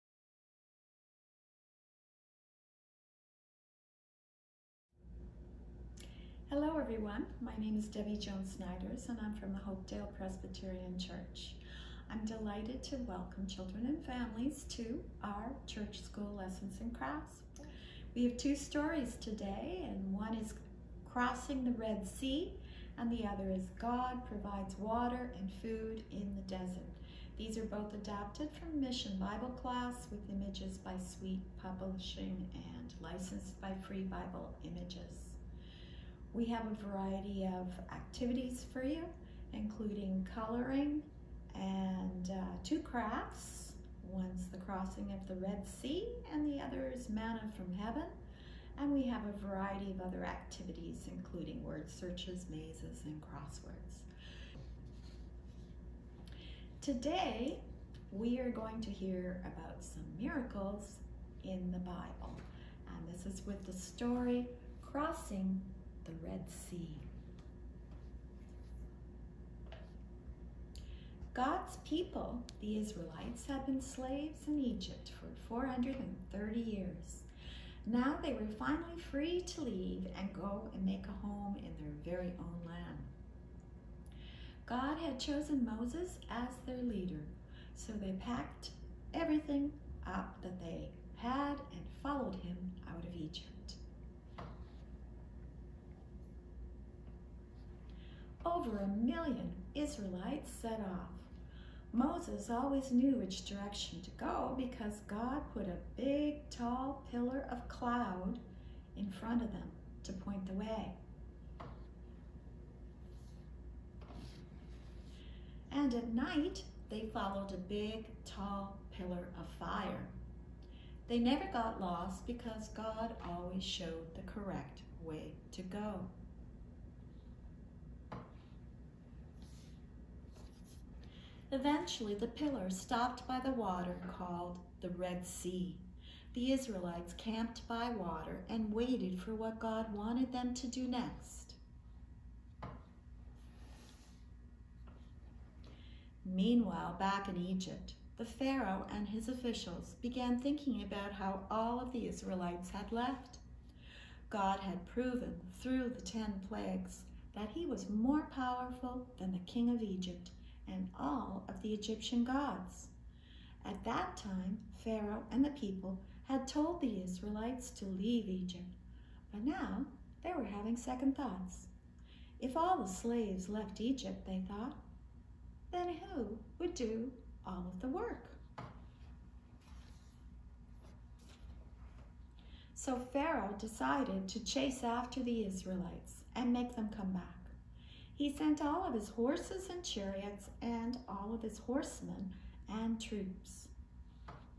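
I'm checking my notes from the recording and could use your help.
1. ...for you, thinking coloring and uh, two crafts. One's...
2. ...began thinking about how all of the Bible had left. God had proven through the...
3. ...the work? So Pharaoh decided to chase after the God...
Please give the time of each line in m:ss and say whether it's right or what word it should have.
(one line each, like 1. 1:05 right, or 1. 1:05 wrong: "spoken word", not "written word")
1. 0:38 wrong: "including", not "thinking"
2. 2:30 wrong: "Israelites", not "Bible"
3. 2:57 wrong: "Israelites", not "God".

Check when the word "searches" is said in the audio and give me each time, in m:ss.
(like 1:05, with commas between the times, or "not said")
0:51.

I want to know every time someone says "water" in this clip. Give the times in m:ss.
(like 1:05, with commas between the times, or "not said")
0:24, 2:13, 2:17.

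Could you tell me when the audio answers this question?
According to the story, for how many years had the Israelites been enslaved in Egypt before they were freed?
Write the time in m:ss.
1:15.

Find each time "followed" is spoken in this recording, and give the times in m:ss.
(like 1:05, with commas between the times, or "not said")
1:32, 1:57.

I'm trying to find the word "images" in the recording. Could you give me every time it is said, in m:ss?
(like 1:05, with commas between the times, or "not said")
0:30, 0:34.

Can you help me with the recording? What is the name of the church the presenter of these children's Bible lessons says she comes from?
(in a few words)
Hopedale Presbyterian Church.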